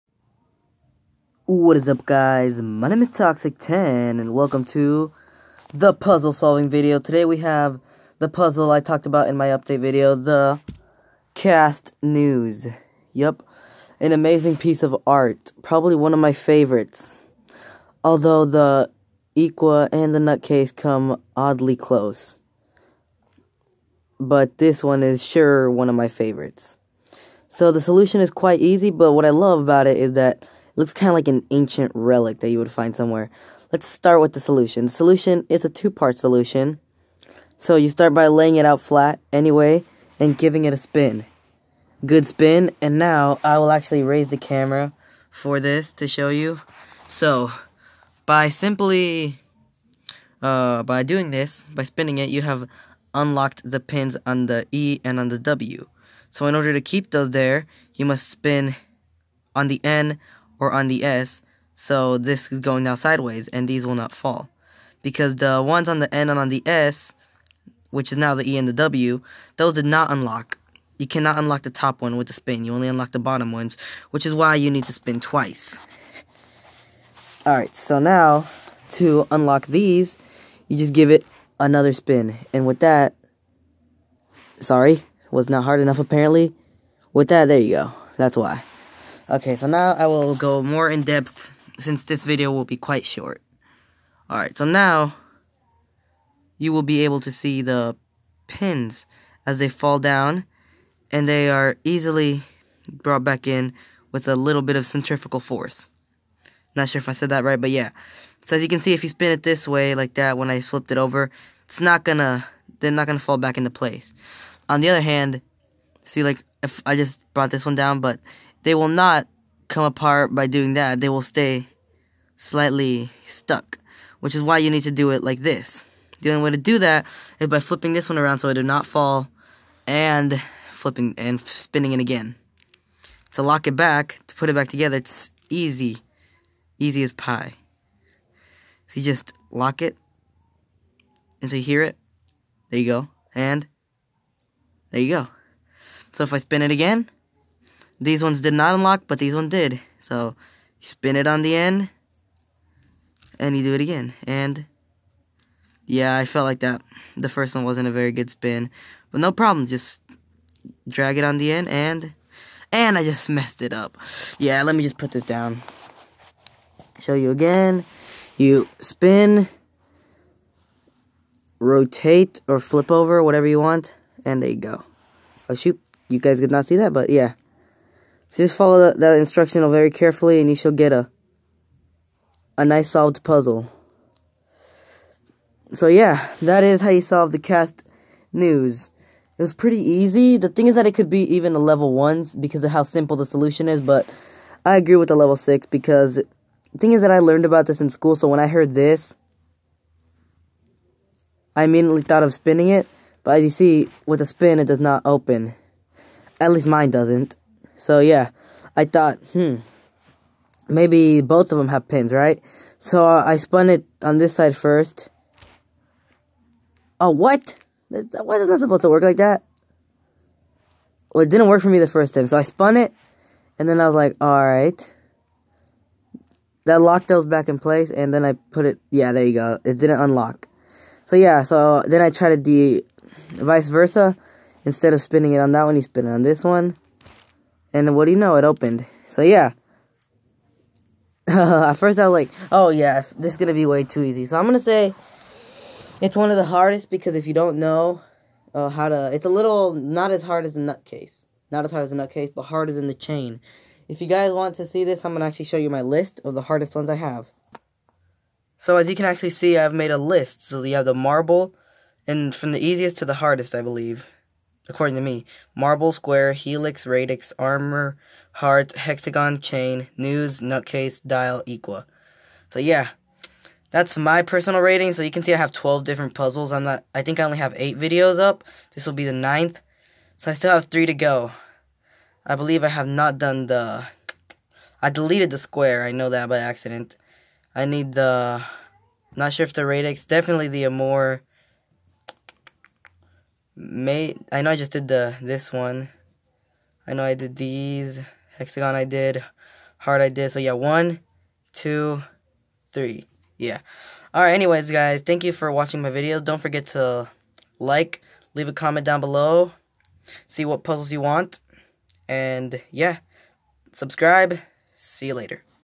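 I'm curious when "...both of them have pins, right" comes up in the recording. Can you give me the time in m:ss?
3:31.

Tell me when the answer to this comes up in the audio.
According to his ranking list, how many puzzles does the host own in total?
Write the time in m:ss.
4:35.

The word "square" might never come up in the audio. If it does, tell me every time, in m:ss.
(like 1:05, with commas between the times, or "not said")
4:25, 4:45.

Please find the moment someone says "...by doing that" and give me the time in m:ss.
2:00.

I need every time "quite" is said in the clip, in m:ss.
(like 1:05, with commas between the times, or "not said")
0:28, 1:32.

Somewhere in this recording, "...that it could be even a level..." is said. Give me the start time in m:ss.
3:10.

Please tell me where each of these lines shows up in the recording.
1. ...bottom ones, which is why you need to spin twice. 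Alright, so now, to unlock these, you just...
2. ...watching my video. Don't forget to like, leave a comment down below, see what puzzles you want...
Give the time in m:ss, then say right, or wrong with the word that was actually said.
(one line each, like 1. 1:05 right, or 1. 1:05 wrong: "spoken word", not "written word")
1. 1:13 right
2. 5:05 right.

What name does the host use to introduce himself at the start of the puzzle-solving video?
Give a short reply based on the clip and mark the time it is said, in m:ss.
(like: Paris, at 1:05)
Toxic10, at 0:03.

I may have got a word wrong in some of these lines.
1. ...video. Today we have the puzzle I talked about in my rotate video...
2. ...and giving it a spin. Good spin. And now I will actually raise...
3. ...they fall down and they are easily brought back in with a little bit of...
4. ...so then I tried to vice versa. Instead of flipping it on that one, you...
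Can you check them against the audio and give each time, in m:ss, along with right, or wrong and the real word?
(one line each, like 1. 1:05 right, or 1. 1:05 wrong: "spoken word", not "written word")
1. 0:06 wrong: "update", not "rotate"
2. 0:40 right
3. 1:39 right
4. 3:51 wrong: "spinning", not "flipping".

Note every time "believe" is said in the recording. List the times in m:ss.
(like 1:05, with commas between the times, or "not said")
4:23, 4:42.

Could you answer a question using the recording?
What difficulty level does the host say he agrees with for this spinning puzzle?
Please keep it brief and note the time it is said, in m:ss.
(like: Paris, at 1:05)
level 6, at 3:15.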